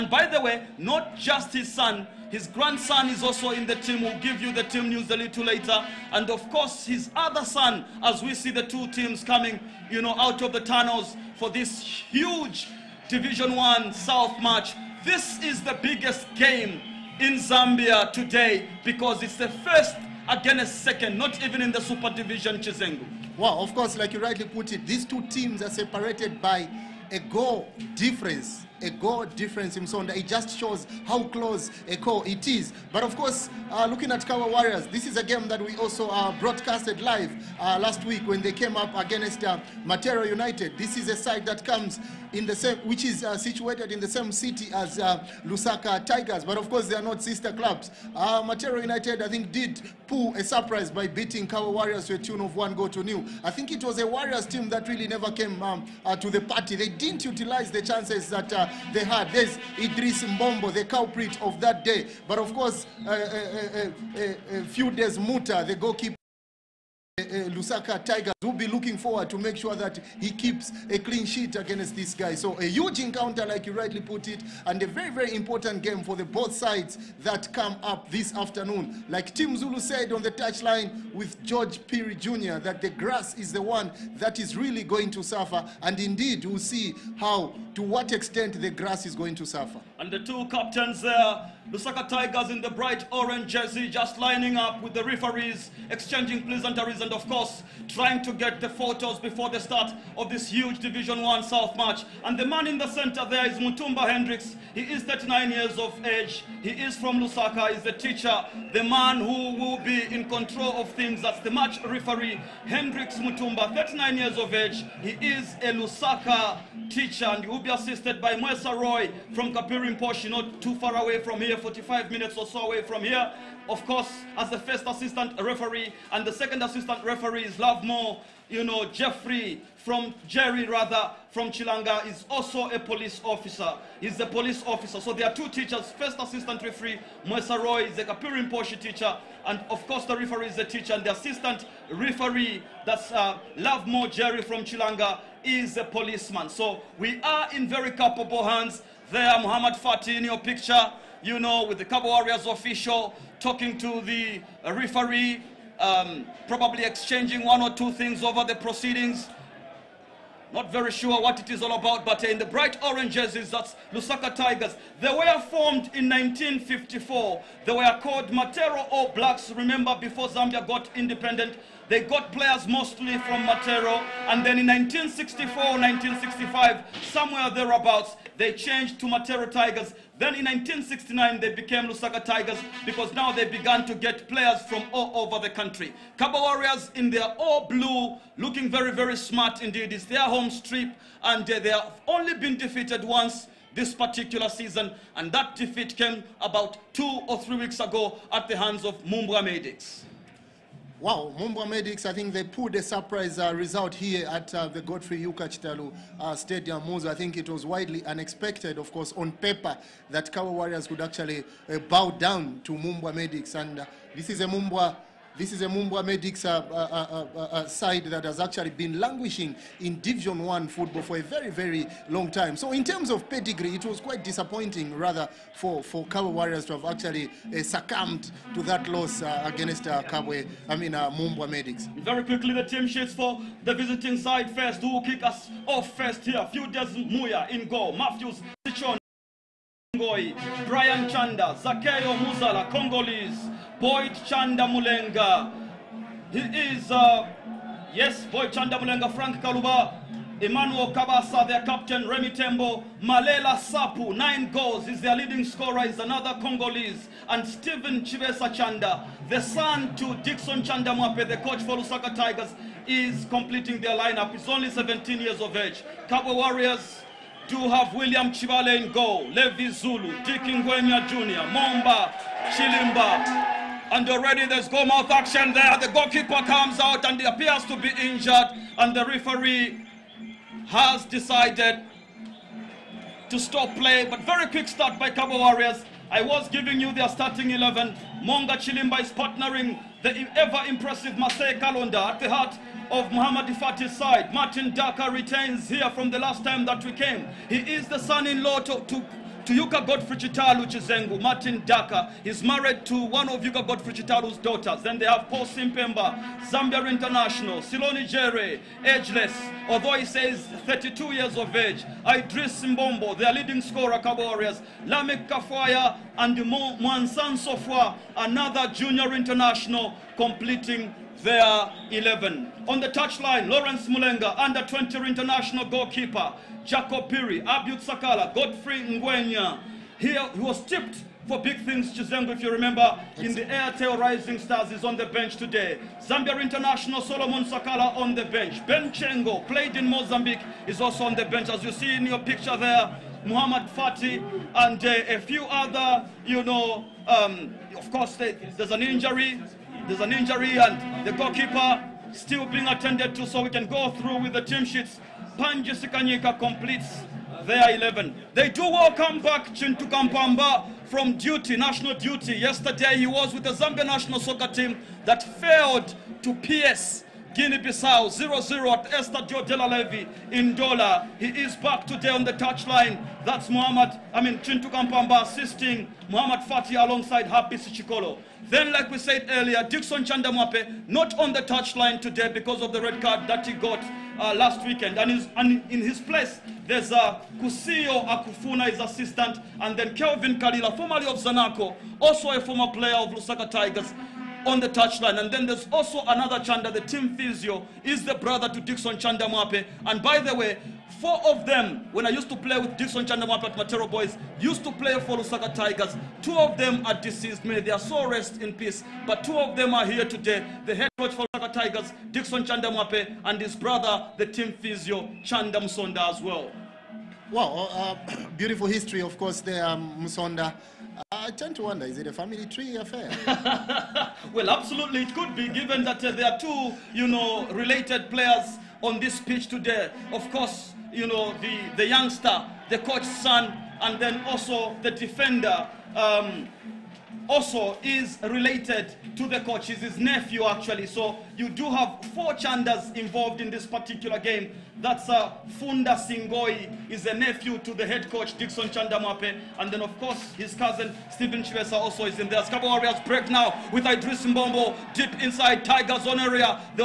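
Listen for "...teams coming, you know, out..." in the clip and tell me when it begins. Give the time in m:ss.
0:08.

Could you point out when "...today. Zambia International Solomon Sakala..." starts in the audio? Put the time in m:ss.
5:35.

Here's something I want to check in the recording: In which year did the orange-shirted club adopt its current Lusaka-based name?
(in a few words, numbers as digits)
1969.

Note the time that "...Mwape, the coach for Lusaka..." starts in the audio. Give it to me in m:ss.
4:20.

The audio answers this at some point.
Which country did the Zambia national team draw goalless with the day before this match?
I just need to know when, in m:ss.
6:07.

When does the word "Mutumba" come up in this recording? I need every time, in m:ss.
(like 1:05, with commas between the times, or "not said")
1:43, 1:53.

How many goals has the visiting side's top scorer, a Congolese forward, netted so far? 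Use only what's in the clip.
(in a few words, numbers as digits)
9.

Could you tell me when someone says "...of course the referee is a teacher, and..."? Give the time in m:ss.
2:19.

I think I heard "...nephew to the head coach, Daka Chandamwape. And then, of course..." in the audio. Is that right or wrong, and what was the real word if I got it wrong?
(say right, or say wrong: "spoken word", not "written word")
wrong: "Dixon", not "Daka".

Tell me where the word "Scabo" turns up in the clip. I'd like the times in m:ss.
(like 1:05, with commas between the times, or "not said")
7:32.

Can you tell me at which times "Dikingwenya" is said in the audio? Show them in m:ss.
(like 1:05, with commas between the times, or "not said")
4:30.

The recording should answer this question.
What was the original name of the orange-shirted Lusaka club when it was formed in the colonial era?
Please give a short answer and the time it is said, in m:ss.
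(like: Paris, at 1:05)
Matero All Blacks, at 2:48.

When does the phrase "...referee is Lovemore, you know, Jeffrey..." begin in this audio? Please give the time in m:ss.
2:07.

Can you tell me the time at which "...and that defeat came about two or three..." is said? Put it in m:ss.
3:15.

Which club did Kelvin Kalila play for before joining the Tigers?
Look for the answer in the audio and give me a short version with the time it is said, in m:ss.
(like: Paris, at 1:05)
Zanaco, at 6:31.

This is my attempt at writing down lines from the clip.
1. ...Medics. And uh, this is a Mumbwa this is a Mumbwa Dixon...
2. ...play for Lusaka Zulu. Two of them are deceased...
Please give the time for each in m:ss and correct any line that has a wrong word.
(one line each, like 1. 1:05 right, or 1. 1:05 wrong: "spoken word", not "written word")
1. 3:33 wrong: "Medics", not "Dixon"
2. 6:44 wrong: "Tigers", not "Zulu".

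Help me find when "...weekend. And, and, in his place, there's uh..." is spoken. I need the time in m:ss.
6:24.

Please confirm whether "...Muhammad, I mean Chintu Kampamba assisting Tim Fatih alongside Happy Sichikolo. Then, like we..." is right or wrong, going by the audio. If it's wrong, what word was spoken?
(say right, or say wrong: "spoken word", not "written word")
wrong: "Muhammad", not "Tim".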